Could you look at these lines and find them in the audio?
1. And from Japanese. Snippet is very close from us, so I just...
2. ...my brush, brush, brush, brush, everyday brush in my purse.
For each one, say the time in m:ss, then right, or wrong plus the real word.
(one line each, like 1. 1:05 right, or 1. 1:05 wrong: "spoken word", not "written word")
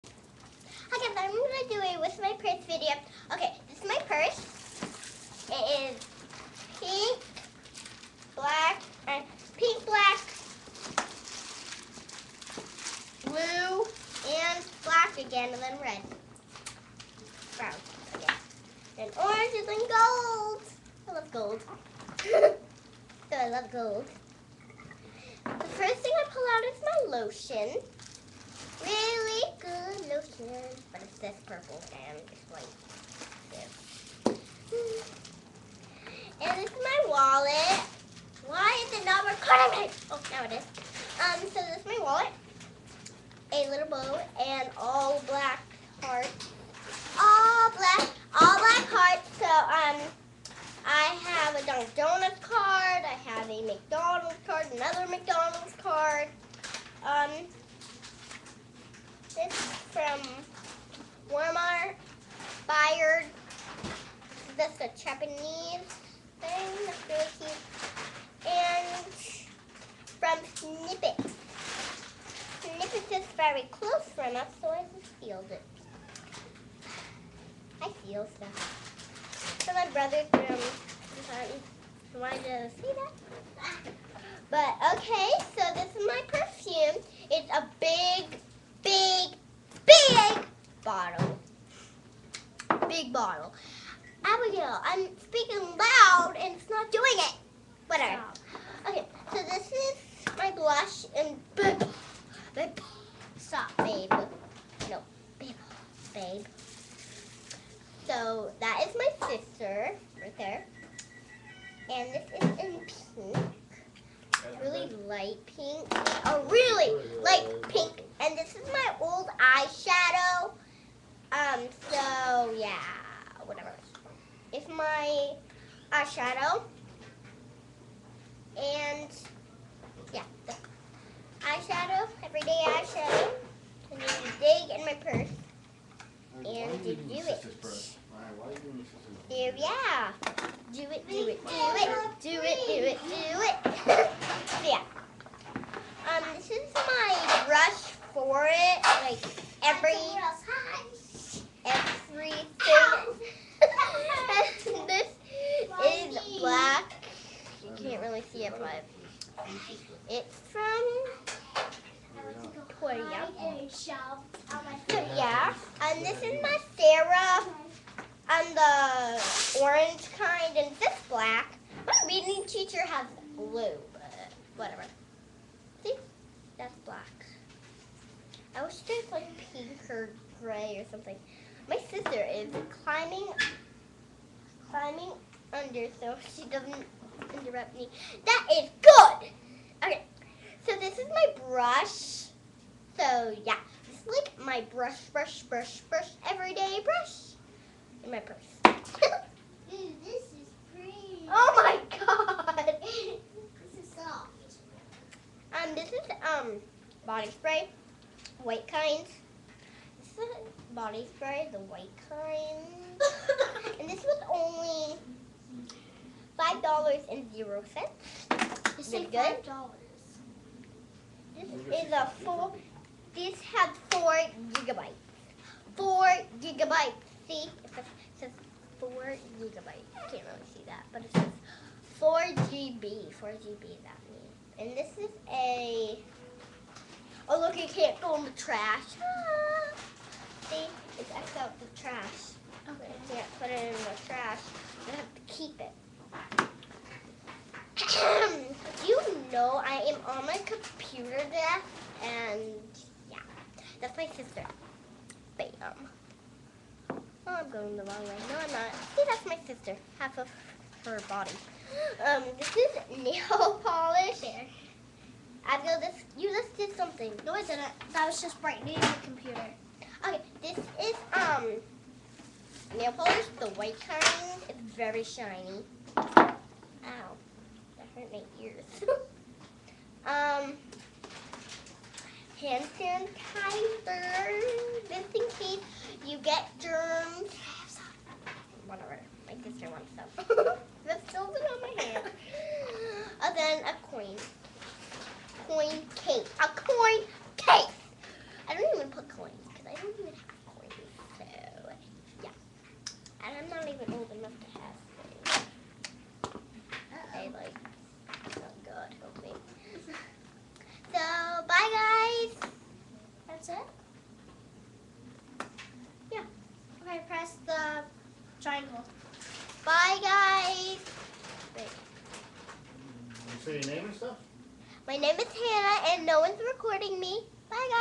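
1. 1:08 wrong: "Snippet", not "Japanese"
2. 3:14 right.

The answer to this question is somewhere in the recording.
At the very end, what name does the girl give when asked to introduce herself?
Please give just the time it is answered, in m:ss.
5:25.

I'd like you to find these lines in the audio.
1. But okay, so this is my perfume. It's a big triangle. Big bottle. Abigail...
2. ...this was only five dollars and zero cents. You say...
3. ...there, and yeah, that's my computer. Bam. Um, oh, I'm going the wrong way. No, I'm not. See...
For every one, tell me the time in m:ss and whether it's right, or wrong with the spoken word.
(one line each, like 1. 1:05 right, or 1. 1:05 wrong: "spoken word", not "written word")
1. 1:24 wrong: "bottle", not "triangle"
2. 3:33 right
3. 4:11 wrong: "sister", not "computer".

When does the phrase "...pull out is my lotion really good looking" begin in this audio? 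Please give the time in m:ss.
0:26.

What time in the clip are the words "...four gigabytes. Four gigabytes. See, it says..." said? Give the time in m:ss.
3:43.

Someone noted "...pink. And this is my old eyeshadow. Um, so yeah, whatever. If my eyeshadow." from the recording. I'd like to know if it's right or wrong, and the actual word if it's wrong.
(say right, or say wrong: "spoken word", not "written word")
right.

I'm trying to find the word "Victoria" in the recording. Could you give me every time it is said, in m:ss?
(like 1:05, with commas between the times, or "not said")
2:42.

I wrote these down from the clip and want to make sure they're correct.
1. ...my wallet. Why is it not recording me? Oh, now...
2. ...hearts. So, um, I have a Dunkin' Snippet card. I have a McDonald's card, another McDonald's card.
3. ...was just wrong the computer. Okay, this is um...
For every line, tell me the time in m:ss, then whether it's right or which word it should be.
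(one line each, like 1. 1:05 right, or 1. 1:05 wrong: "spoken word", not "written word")
1. 0:36 right
2. 0:48 wrong: "Donuts", not "Snippet"
3. 4:28 wrong: "brightening", not "wrong".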